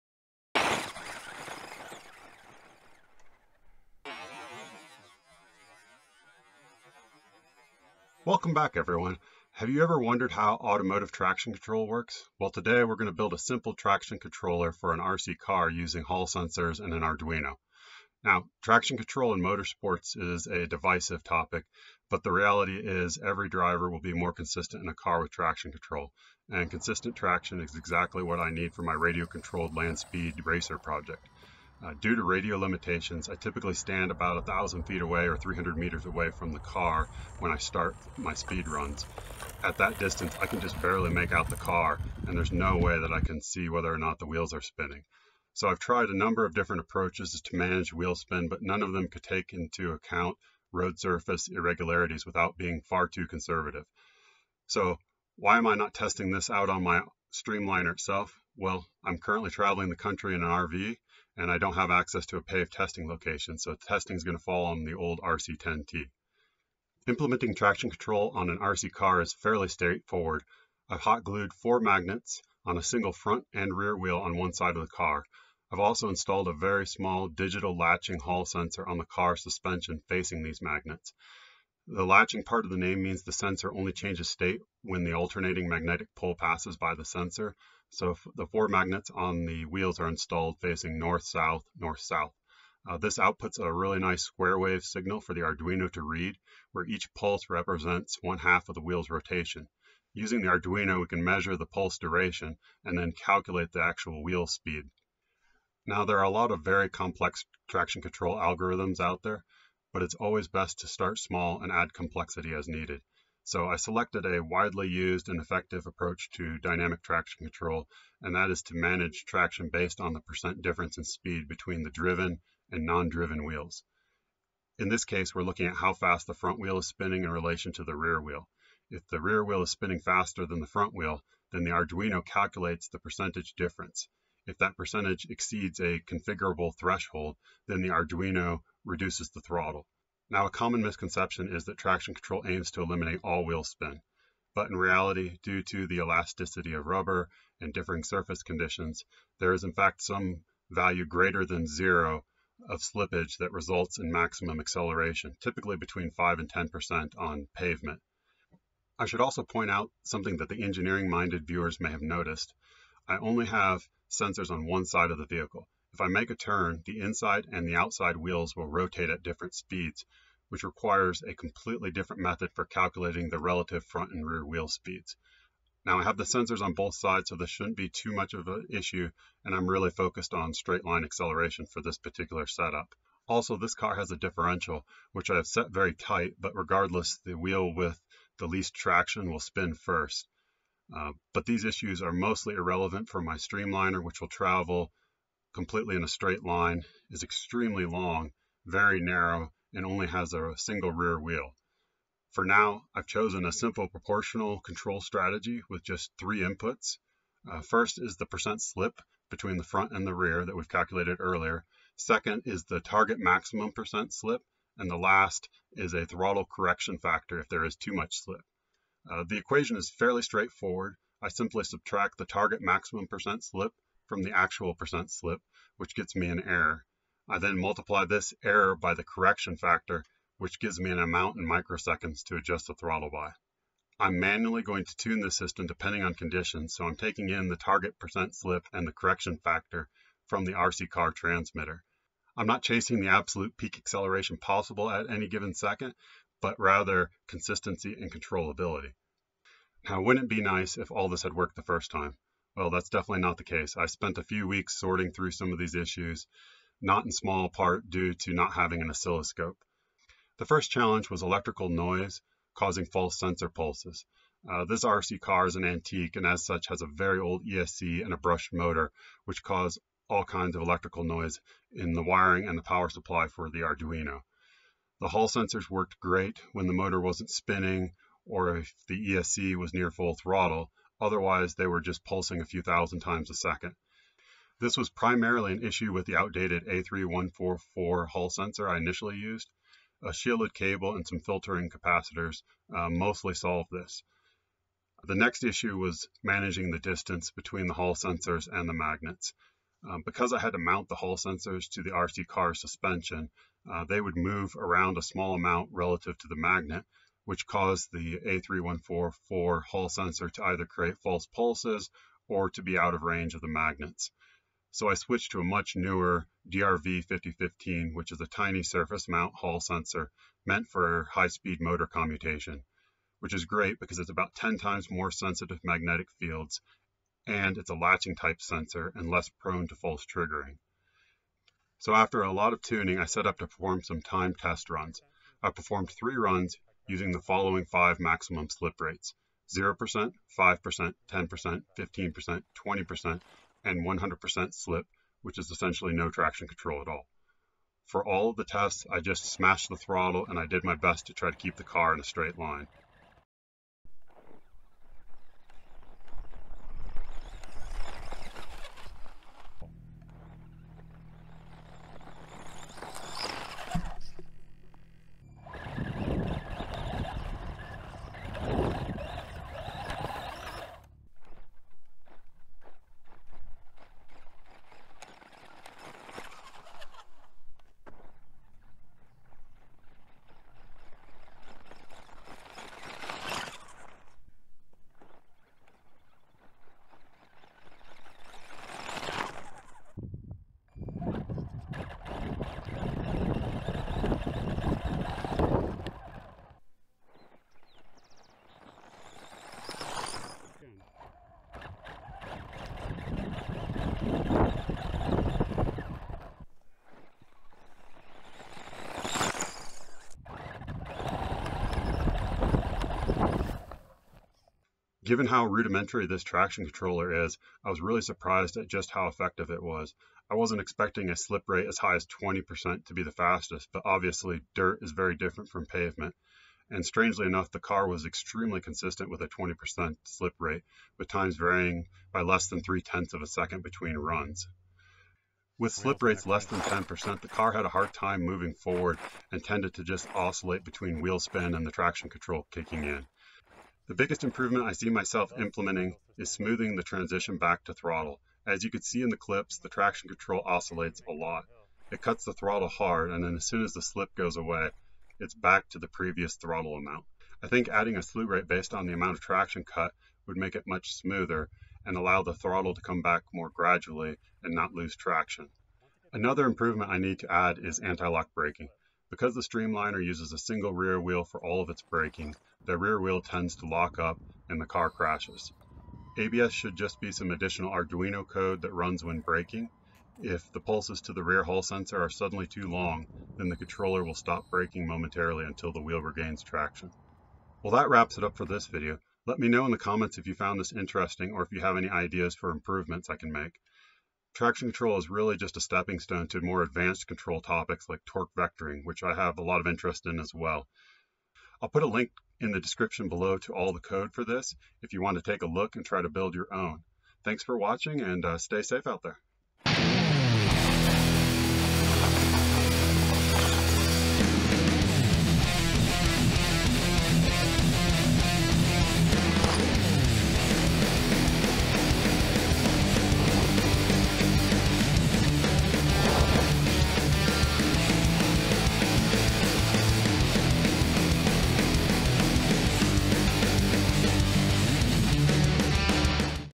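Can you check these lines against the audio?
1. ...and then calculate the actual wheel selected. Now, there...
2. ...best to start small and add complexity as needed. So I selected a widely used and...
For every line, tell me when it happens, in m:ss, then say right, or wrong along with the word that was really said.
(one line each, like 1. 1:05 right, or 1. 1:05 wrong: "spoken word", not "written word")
1. 1:42 wrong: "speed", not "selected"
2. 1:50 right.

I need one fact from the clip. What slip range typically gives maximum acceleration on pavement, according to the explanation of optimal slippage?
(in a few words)
5 to 10%.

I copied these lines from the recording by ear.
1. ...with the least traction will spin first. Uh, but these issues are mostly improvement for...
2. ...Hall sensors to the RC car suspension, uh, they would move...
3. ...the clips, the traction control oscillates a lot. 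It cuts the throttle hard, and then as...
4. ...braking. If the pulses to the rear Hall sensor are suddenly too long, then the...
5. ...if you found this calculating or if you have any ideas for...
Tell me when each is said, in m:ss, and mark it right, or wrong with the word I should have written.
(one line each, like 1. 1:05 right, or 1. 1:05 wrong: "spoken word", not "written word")
1. 3:07 wrong: "irrelevant", not "improvement"
2. 5:00 right
3. 7:29 right
4. 7:59 right
5. 8:10 wrong: "interesting", not "calculating".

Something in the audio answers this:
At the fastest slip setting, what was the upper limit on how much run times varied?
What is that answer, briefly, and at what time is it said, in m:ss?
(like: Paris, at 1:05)
three tenths of a second, at 7:12.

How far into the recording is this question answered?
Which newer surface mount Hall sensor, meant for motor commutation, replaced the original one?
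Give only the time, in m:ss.
5:16.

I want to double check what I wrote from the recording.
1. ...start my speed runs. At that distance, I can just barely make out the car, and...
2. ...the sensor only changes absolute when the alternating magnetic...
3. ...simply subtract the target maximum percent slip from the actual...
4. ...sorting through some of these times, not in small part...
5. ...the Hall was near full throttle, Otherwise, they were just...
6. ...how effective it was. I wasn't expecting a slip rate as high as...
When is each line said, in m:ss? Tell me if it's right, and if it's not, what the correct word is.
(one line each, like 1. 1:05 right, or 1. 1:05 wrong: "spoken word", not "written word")
1. 0:37 right
2. 1:23 wrong: "state", not "absolute"
3. 3:41 right
4. 4:14 wrong: "issues", not "times"
5. 4:38 wrong: "ESC", not "Hall"
6. 6:58 right.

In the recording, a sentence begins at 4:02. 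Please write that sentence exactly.
I'm not chasing the absolute peak acceleration possible at any given second, but rather consistency and controllability.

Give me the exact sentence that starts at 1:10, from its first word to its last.
I've hot glued four magnets on a single front and rear wheel on one side of the car.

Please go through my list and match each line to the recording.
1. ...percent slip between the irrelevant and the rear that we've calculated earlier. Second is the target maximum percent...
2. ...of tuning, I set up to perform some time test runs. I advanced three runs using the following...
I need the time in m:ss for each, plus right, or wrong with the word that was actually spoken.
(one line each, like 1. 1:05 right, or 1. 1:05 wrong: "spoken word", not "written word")
1. 3:28 wrong: "front", not "irrelevant"
2. 5:32 wrong: "performed", not "advanced".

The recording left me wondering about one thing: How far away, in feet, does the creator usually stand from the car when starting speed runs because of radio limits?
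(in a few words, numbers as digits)
1,000 feet.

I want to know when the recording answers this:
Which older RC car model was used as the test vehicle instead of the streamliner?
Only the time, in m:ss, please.
1:05.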